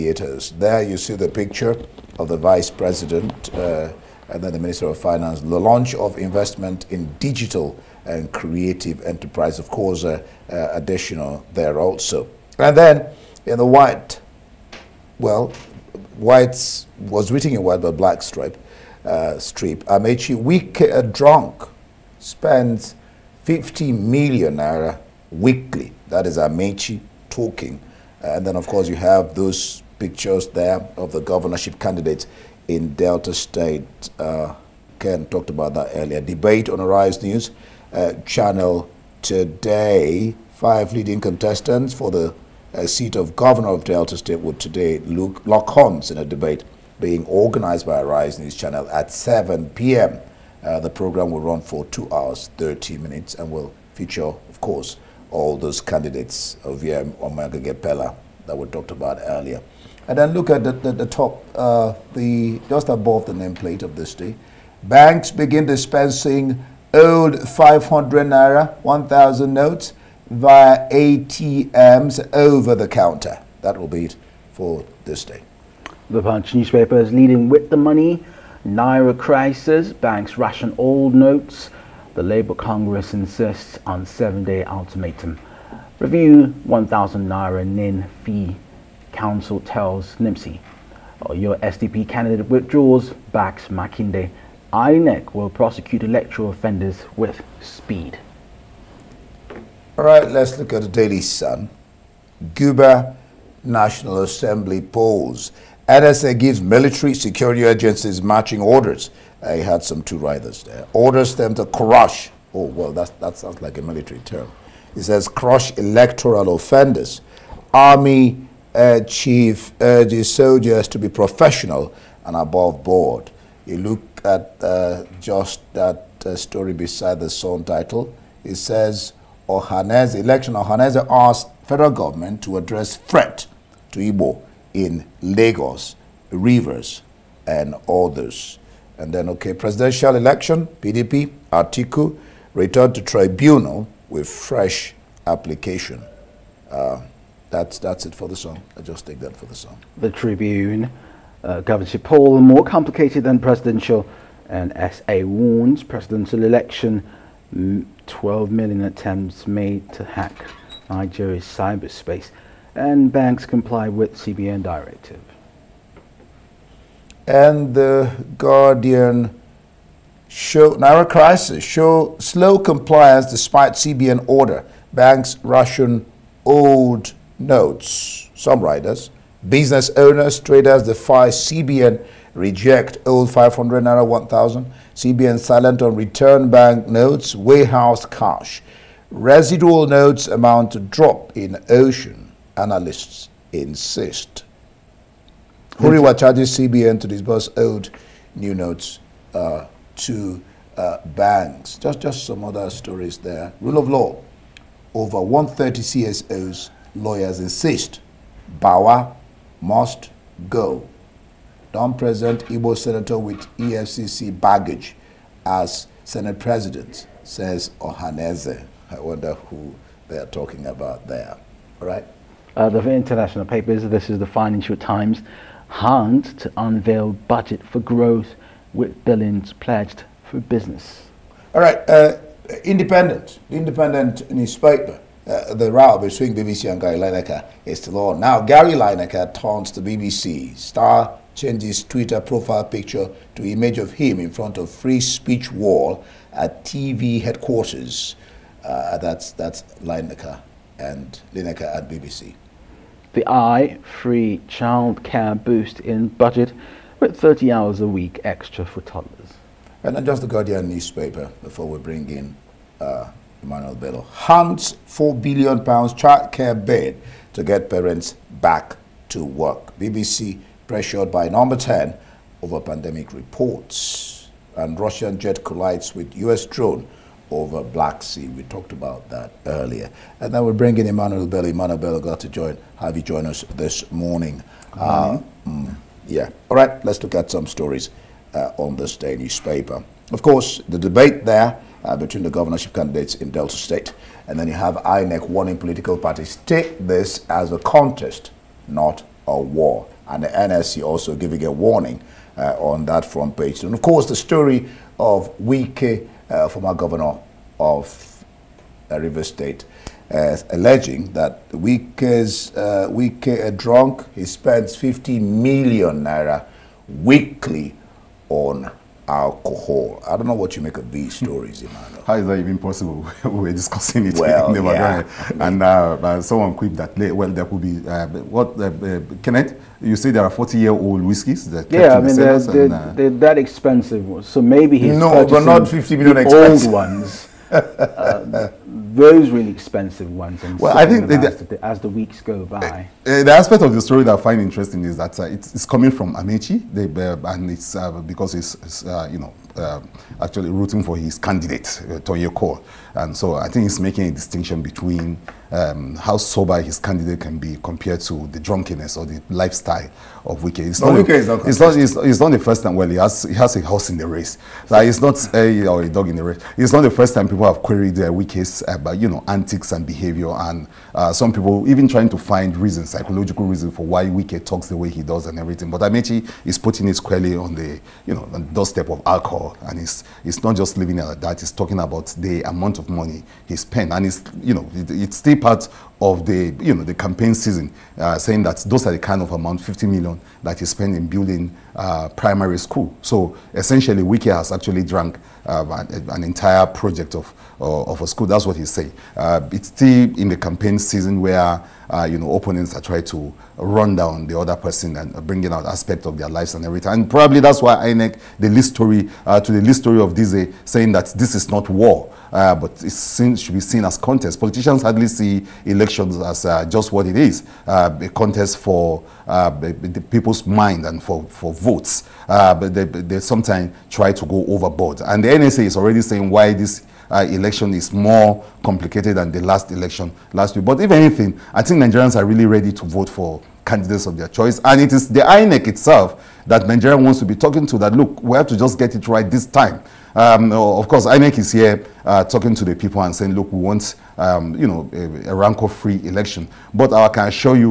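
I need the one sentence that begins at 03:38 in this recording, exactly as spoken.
I wonder who they are talking about there.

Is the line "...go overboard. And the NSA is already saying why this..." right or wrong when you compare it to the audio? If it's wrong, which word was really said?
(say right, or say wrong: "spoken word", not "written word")
right.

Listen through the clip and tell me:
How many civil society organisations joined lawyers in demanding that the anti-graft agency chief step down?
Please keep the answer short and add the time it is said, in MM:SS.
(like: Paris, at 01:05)
Over 130, at 03:24.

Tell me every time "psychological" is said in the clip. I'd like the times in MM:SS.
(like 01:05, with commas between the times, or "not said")
06:12.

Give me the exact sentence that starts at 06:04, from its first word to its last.
Like, it's not a, or a dog in the race.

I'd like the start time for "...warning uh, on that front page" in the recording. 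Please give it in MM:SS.
05:01.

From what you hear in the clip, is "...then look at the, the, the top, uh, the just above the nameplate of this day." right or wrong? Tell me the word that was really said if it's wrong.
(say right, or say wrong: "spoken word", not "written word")
right.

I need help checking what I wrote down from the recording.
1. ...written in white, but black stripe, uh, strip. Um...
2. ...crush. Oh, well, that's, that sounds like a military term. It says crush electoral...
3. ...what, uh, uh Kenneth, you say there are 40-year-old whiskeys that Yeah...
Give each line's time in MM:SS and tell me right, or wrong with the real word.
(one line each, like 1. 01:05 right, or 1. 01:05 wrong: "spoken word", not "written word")
1. 00:17 right
2. 01:51 right
3. 05:28 right.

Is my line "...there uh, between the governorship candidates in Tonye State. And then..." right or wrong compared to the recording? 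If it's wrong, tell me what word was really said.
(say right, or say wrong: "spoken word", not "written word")
wrong: "Delta", not "Tonye".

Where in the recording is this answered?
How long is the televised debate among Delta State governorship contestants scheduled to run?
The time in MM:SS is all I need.
00:51.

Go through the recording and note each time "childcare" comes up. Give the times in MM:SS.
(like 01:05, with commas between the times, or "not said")
04:14, 04:25.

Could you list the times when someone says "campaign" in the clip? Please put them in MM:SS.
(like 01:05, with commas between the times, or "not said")
06:26, 06:40.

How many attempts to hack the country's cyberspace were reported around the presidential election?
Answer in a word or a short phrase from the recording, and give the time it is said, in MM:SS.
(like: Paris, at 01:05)
12 million, at 02:38.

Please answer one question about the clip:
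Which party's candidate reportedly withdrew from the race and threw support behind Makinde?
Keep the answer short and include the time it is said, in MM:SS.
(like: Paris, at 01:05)
SDP, at 01:31.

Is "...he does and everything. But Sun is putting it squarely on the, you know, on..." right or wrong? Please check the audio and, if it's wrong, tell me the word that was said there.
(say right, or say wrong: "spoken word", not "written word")
wrong: "Amaechi", not "Sun".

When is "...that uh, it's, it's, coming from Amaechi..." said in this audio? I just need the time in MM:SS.
05:44.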